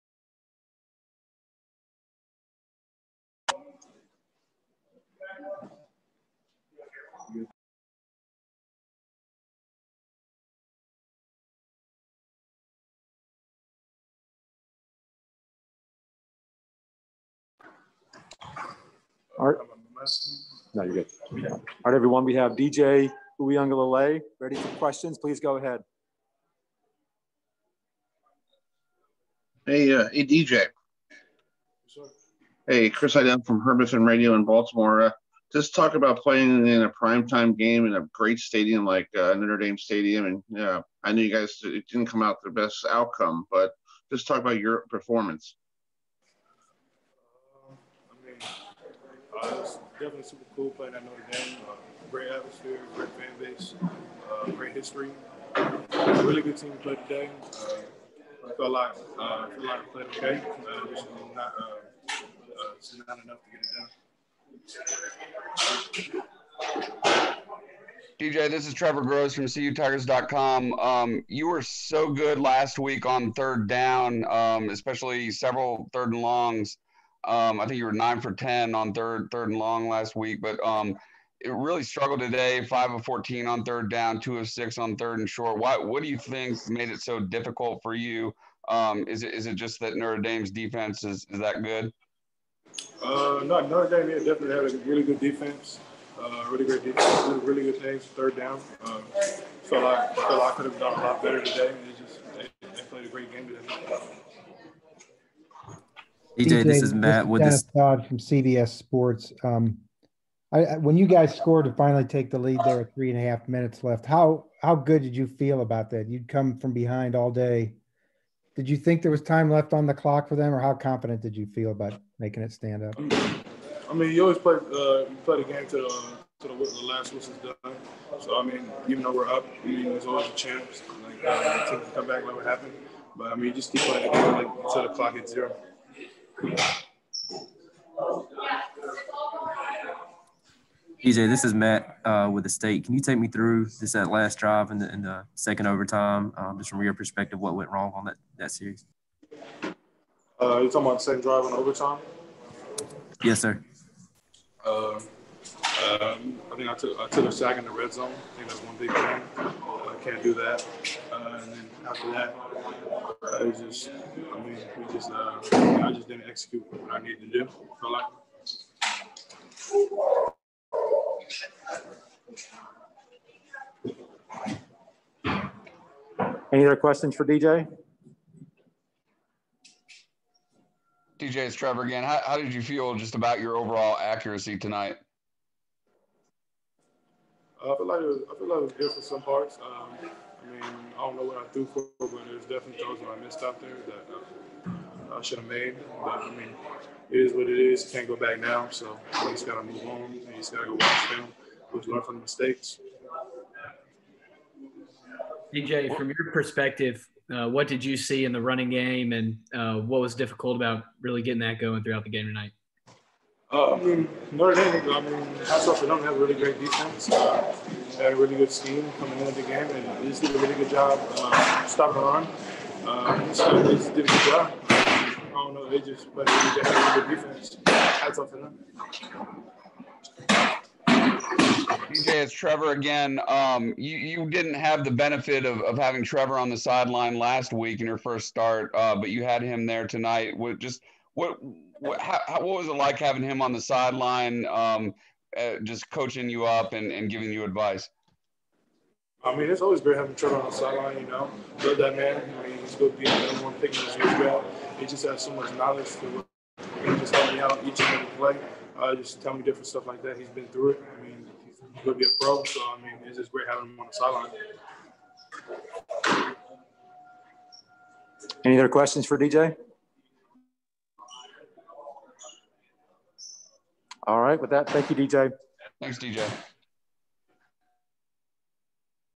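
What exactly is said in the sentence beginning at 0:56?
Really good team to play today.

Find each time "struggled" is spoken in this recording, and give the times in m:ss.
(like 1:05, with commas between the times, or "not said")
1:21.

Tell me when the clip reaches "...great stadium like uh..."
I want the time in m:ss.
0:38.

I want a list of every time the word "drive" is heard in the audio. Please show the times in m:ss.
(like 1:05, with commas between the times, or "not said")
2:24, 2:31.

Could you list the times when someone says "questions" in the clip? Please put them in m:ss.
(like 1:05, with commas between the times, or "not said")
0:24, 2:56, 4:28.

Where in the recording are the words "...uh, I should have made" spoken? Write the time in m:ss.
3:15.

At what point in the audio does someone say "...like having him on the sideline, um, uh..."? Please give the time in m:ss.
4:02.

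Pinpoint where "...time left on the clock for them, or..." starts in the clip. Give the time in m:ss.
1:59.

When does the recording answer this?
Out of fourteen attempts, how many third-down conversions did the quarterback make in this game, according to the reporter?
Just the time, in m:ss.
1:22.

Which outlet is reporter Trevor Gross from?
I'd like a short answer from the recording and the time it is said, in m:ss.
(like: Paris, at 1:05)
CUTigers.com, at 1:09.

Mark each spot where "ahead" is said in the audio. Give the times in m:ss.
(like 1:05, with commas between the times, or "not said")
0:25.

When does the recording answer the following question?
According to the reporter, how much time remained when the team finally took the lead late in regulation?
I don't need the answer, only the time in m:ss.
1:52.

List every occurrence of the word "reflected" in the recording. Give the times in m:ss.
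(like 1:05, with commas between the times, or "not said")
not said.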